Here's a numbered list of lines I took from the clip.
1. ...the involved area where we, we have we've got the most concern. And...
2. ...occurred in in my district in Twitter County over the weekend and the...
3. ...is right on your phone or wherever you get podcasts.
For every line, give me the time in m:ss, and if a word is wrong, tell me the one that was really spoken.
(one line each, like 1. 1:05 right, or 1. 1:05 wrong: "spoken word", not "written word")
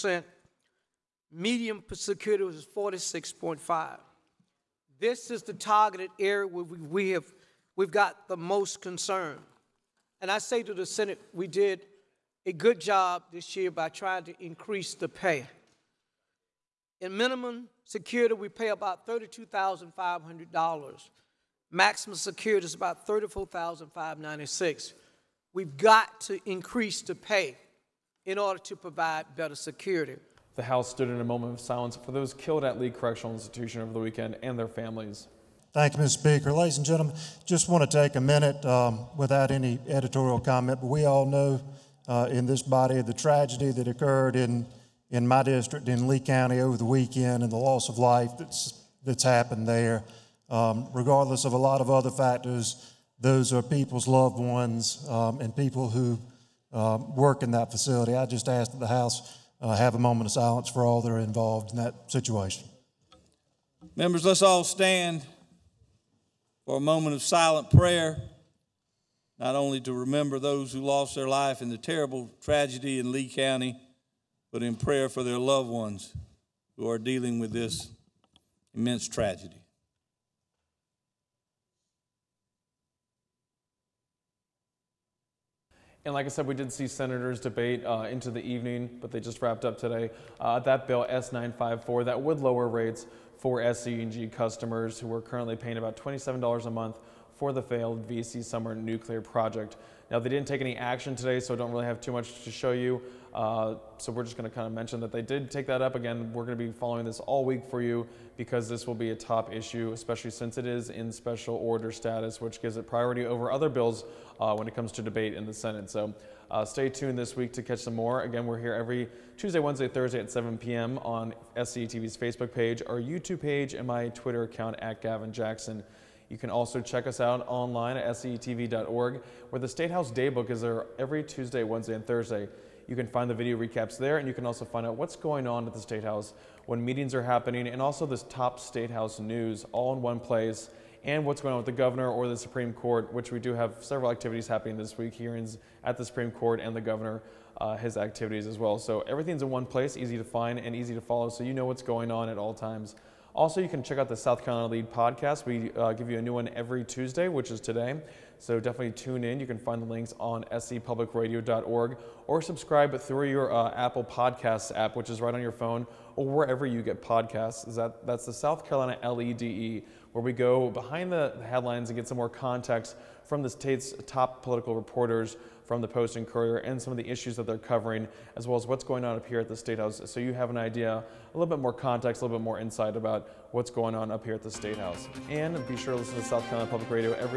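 1. 0:05 wrong: "targeted", not "involved"
2. 0:43 wrong: "Lee", not "Twitter"
3. 2:45 right.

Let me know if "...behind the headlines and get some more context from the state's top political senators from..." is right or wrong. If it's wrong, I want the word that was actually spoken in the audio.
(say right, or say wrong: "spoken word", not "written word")
wrong: "reporters", not "senators".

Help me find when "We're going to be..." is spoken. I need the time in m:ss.
1:46.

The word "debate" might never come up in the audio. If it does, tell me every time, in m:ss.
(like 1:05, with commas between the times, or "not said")
1:27, 1:55.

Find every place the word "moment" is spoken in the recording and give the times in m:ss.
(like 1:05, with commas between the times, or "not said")
0:31, 0:59, 1:06.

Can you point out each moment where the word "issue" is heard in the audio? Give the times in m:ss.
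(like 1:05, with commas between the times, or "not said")
1:49, 2:57.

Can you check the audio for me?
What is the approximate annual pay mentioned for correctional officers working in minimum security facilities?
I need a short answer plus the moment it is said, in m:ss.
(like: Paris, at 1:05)
$32,500, at 0:19.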